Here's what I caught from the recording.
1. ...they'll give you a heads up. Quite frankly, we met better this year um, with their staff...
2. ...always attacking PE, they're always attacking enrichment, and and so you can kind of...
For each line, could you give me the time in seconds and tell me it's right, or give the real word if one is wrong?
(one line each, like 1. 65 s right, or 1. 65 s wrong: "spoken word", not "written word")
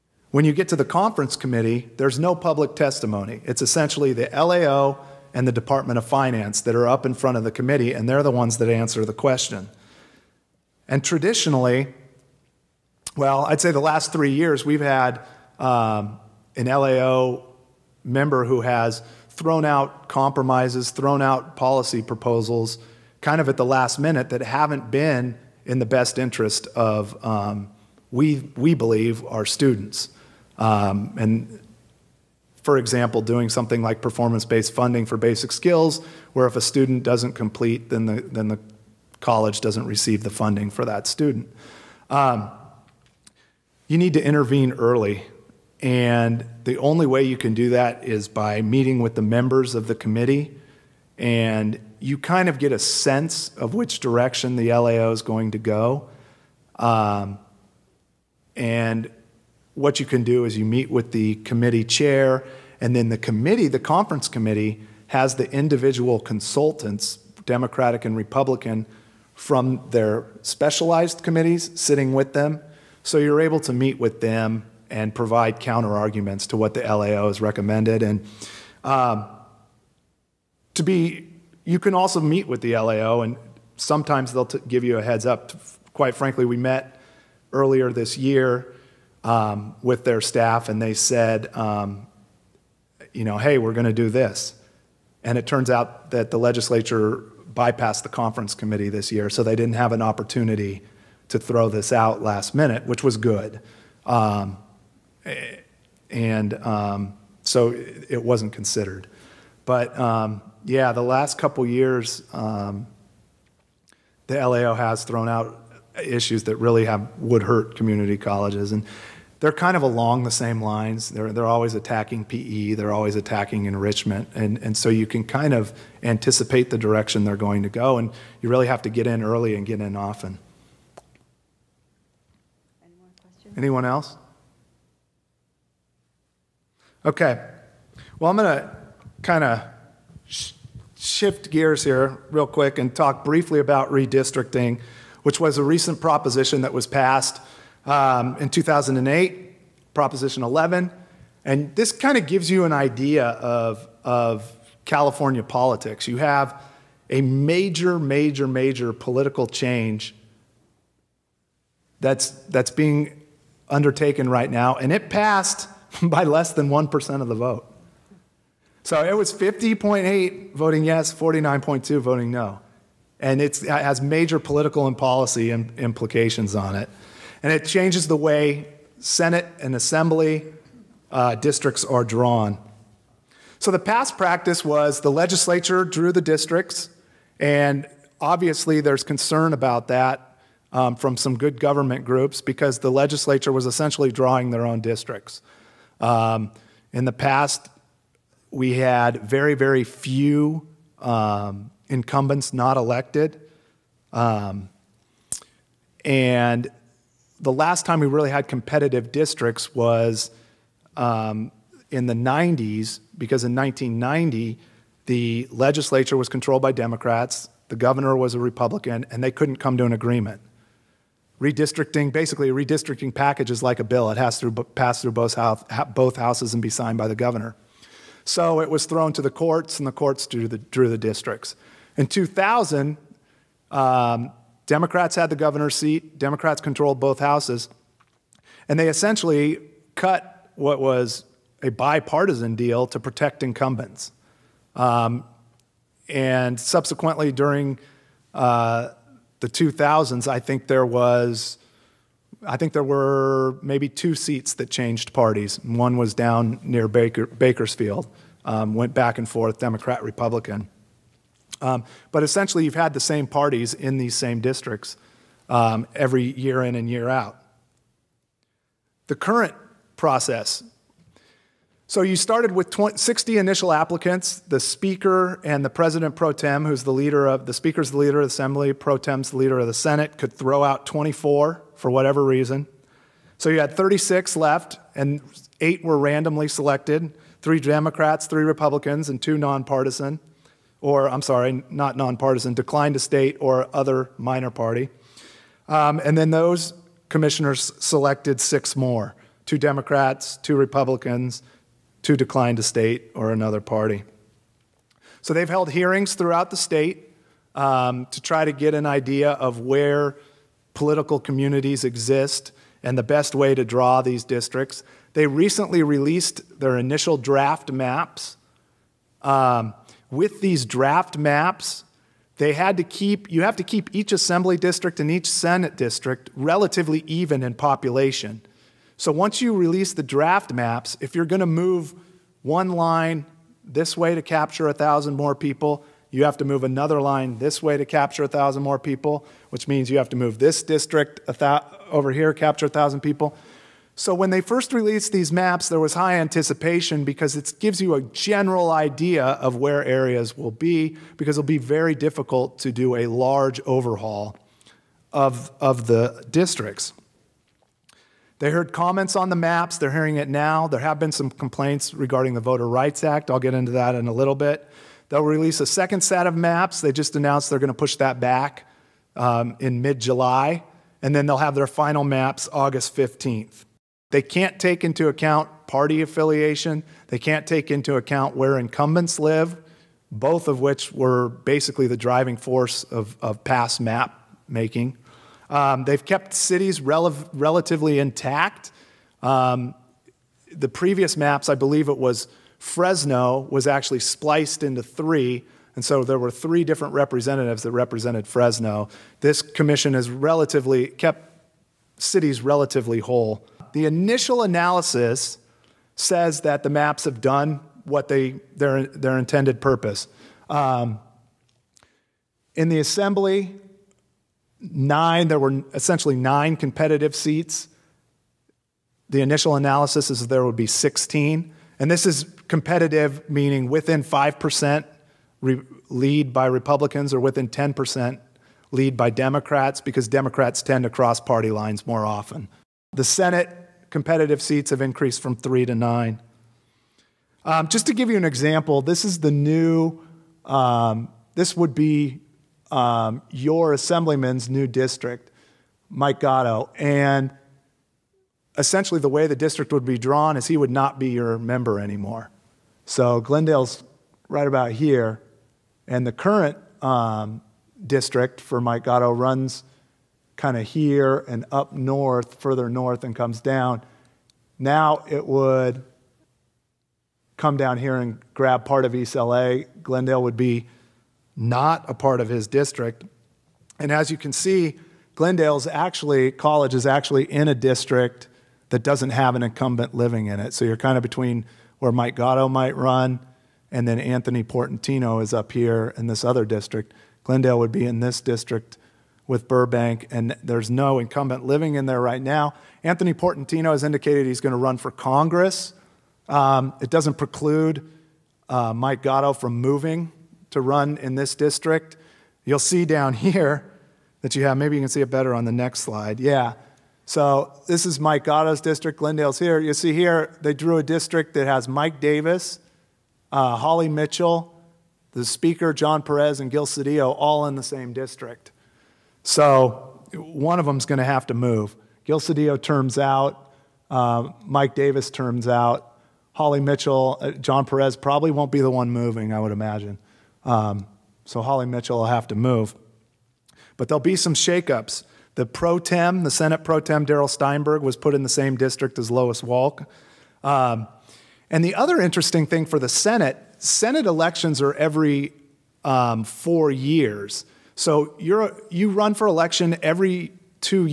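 1. 84 s wrong: "earlier", not "better"
2. 121 s right.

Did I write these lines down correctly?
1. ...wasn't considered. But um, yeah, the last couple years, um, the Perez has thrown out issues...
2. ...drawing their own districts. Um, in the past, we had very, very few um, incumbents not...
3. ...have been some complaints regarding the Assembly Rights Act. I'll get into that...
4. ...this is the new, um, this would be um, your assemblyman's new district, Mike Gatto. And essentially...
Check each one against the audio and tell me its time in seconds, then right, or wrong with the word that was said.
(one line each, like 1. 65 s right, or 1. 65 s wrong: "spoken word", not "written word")
1. 108 s wrong: "LAO", not "Perez"
2. 194 s right
3. 360 s wrong: "Voter", not "Assembly"
4. 438 s right.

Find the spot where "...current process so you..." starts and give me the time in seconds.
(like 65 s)
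269 s.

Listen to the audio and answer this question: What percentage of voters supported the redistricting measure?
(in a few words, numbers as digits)
50.8.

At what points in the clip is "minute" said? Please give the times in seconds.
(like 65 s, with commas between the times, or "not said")
23 s, 102 s.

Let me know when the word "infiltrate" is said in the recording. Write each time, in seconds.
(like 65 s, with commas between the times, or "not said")
not said.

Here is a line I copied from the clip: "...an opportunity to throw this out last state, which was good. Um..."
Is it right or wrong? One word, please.
wrong.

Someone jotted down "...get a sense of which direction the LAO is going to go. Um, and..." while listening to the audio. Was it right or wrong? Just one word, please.
right.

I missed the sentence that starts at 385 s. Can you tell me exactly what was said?
Um, they've kept cities rel relatively intact.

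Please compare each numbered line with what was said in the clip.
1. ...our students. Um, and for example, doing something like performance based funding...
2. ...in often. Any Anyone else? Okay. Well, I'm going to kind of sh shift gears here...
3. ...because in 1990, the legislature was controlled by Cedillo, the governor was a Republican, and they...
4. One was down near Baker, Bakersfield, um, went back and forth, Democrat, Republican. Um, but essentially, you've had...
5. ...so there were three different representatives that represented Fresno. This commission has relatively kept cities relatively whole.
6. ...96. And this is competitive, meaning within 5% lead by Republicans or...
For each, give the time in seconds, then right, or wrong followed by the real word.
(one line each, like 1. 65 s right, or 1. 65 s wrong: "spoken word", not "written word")
1. 29 s right
2. 129 s right
3. 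213 s wrong: "Democrats", not "Cedillo"
4. 255 s right
5. 395 s right
6. 420 s wrong: "16", not "96".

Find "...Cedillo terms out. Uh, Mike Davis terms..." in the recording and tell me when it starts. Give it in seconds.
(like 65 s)
522 s.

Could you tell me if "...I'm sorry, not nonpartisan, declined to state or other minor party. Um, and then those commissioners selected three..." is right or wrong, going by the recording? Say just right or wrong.
wrong.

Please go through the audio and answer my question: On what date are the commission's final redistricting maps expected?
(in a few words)
August 15th.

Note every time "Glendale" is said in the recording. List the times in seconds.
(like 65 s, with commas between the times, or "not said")
453 s, 469 s, 475 s, 487 s, 508 s.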